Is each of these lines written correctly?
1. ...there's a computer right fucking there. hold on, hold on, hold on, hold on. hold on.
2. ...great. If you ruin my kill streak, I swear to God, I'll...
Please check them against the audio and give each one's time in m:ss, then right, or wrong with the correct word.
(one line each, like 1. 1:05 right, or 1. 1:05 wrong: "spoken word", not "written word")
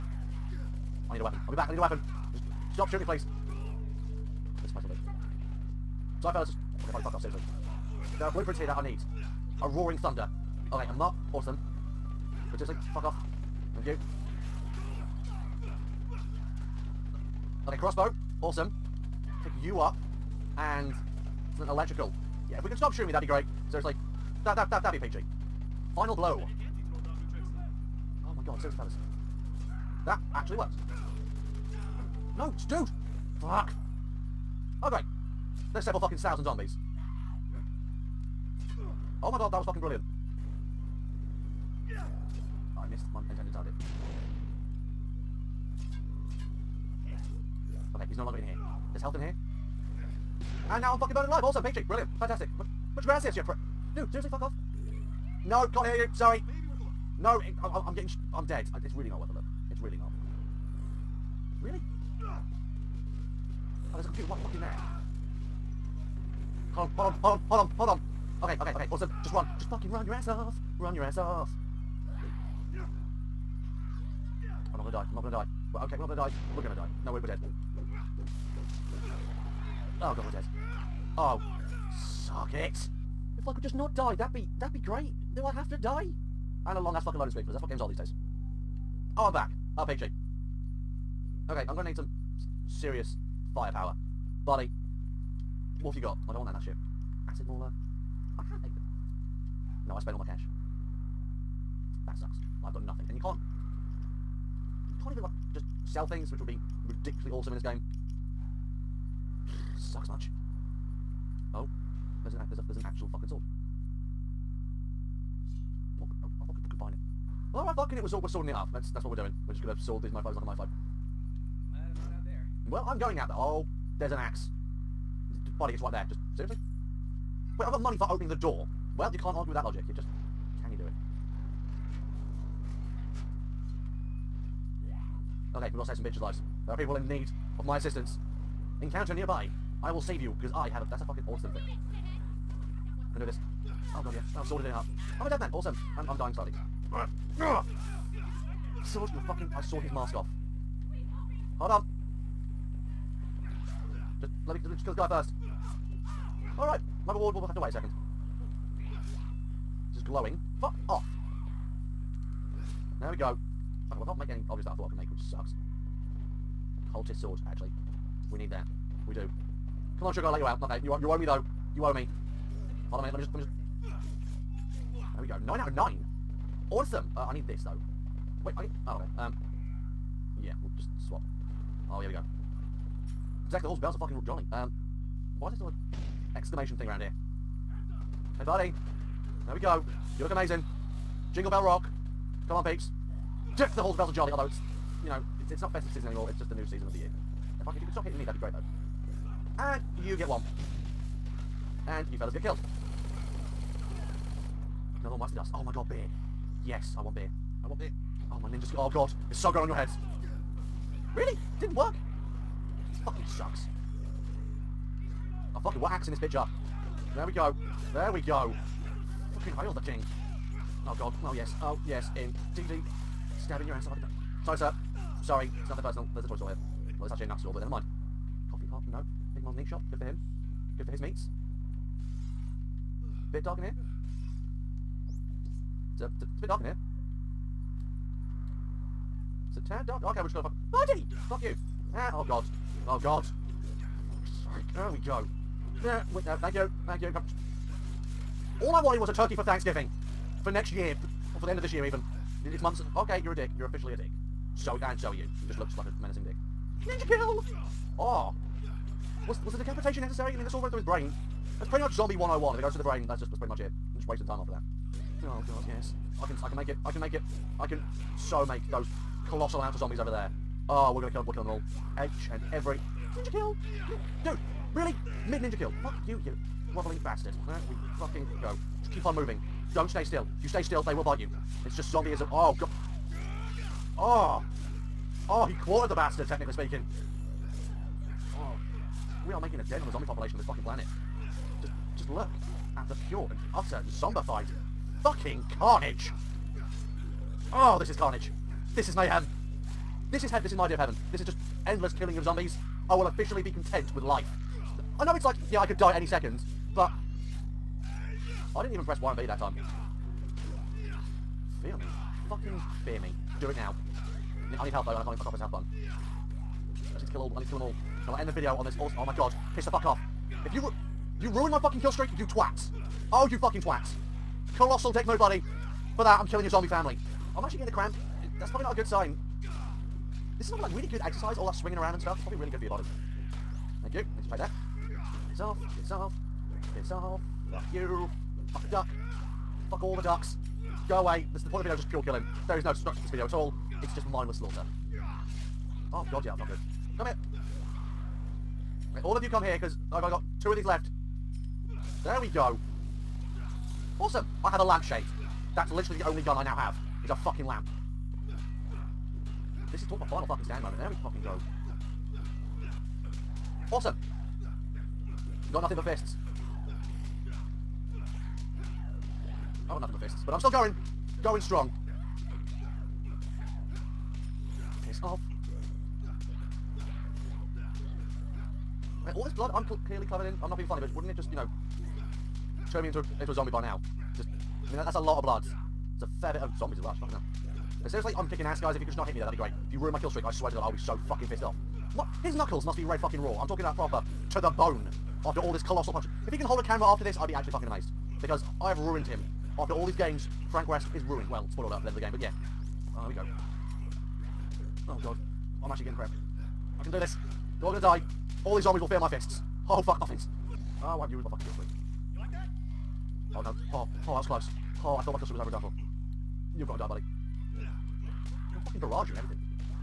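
1. 1:03 right
2. 6:29 right.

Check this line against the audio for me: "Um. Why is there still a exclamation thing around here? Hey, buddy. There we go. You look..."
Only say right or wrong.
right.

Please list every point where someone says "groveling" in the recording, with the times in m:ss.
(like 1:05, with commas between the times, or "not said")
4:36.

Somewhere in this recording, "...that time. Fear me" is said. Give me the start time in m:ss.
5:09.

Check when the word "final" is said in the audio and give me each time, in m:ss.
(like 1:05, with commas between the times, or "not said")
0:25, 6:00.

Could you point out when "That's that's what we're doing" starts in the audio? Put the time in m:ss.
1:58.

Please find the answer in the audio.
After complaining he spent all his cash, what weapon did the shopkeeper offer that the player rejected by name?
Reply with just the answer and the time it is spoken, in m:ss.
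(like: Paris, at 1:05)
Acid Mauler, at 1:37.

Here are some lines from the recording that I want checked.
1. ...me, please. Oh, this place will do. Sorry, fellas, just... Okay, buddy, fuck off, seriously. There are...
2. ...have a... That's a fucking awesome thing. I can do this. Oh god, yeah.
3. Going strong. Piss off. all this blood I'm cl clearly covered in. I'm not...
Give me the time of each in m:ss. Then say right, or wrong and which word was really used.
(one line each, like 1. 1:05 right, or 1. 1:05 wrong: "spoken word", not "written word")
1. 0:03 right
2. 2:20 right
3. 6:11 right.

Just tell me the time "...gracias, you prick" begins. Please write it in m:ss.
0:53.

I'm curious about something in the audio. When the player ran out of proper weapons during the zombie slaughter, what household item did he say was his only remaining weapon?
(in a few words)
A lampshade.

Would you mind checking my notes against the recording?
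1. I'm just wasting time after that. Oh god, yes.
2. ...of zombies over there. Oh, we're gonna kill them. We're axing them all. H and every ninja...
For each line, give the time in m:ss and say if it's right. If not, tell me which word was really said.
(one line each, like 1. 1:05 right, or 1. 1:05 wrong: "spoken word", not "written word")
1. 4:23 right
2. 4:29 wrong: "killing", not "axing".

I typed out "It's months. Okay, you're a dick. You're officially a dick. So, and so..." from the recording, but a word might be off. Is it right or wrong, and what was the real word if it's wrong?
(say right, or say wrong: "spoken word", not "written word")
right.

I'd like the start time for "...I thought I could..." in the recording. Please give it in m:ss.
2:44.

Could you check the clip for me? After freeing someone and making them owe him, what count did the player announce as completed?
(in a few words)
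Nine out of nine.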